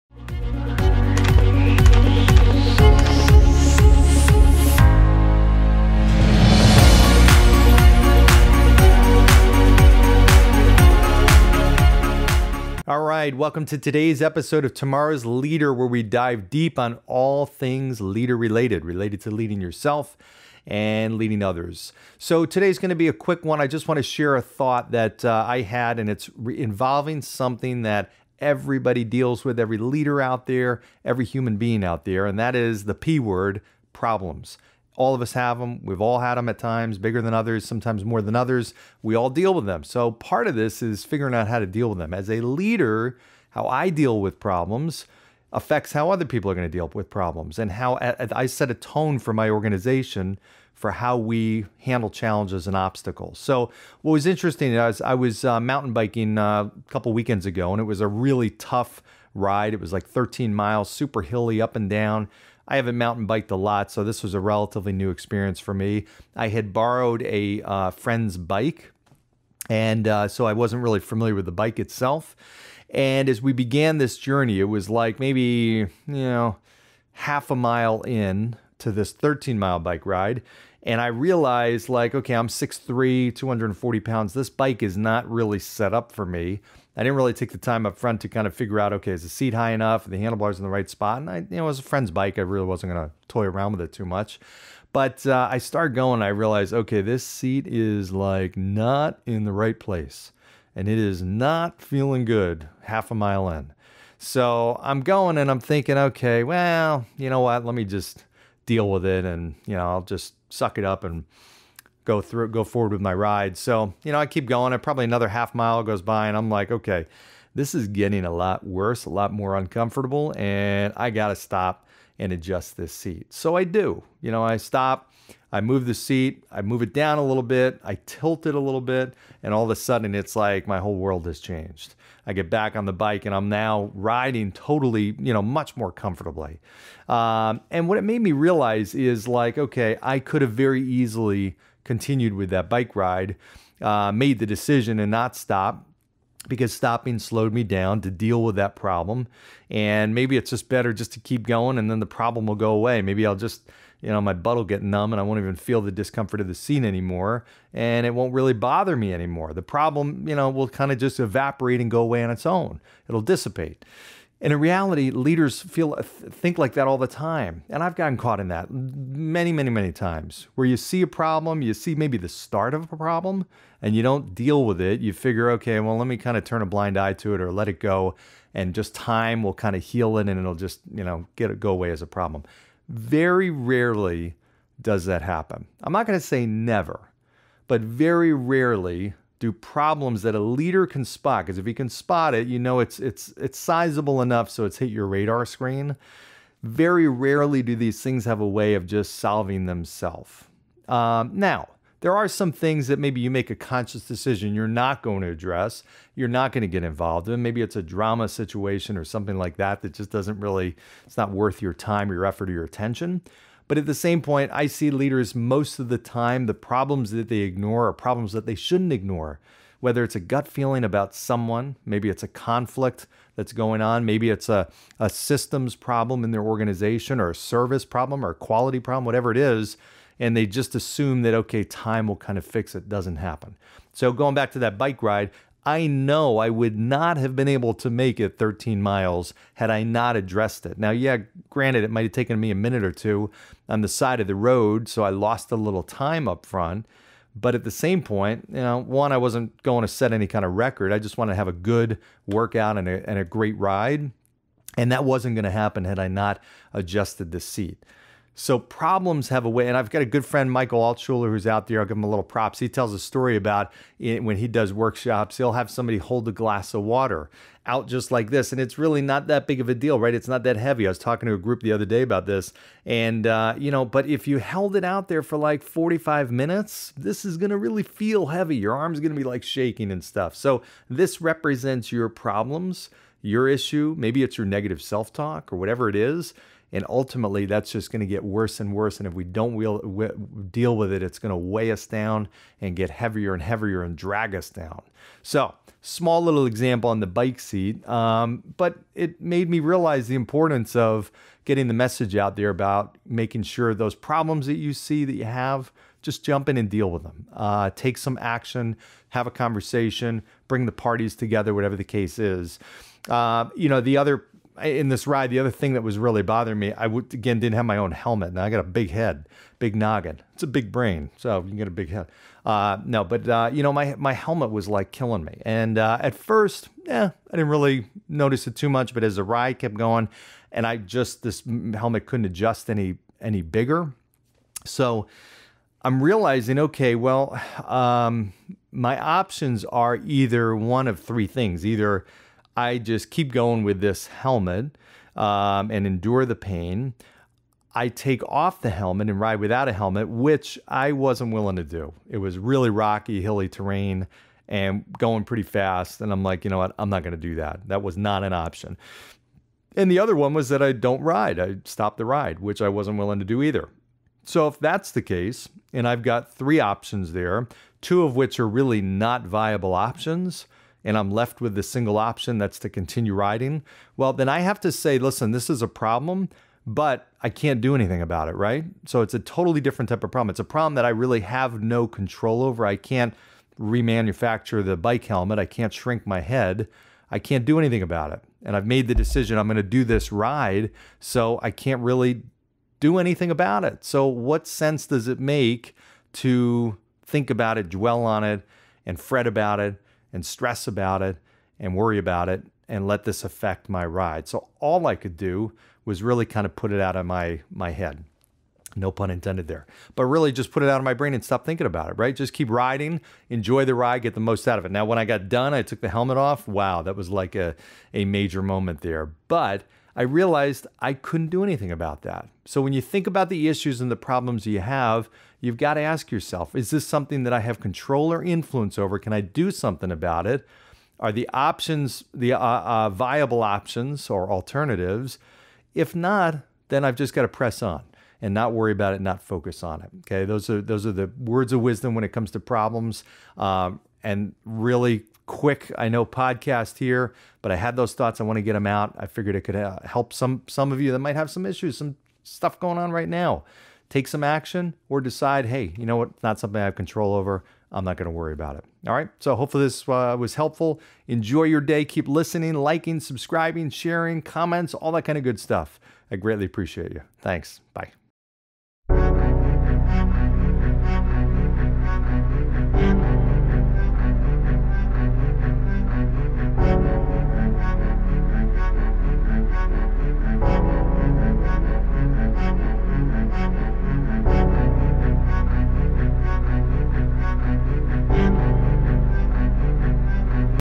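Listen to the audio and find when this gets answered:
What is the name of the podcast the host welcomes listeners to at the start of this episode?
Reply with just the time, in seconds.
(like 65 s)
14 s.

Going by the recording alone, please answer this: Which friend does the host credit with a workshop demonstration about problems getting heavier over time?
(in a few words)
Michael Altshuler.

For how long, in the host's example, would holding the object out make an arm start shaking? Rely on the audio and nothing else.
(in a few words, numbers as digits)
45 minutes.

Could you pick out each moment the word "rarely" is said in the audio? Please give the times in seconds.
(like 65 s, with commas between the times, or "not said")
183 s, 188 s, 197 s.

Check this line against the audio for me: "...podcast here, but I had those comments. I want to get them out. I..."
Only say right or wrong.
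wrong.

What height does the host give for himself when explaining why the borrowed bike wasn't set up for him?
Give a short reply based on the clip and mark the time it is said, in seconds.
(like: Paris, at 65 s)
6'3, at 82 s.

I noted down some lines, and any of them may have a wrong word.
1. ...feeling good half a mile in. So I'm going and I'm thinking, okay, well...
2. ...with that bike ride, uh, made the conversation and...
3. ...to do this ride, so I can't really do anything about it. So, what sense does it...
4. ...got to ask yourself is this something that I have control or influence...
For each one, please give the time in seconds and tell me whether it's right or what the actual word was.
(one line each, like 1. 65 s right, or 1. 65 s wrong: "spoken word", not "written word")
1. 101 s right
2. 142 s wrong: "decision", not "conversation"
3. 389 s right
4. 425 s right.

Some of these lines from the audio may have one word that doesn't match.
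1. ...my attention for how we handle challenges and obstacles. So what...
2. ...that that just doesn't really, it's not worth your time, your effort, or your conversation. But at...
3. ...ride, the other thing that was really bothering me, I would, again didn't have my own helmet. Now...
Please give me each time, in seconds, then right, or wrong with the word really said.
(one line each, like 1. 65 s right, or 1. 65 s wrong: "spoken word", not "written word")
1. 49 s wrong: "organization", not "attention"
2. 209 s wrong: "attention", not "conversation"
3. 315 s right.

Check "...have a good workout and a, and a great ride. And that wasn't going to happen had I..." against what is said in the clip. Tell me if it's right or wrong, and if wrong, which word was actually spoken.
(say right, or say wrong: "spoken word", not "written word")
right.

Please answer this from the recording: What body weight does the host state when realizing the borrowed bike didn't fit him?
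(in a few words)
240 pounds.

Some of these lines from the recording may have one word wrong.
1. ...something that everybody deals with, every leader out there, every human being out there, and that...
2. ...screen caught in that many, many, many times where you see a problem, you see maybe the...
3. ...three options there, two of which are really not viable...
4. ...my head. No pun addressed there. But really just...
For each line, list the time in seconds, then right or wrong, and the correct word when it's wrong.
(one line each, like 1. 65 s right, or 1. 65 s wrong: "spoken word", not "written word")
1. 27 s right
2. 167 s wrong: "gotten", not "screen"
3. 366 s right
4. 407 s wrong: "intended", not "addressed".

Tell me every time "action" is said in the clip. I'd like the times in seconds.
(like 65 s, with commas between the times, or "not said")
308 s, 454 s.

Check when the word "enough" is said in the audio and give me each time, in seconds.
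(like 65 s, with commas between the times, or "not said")
89 s, 194 s.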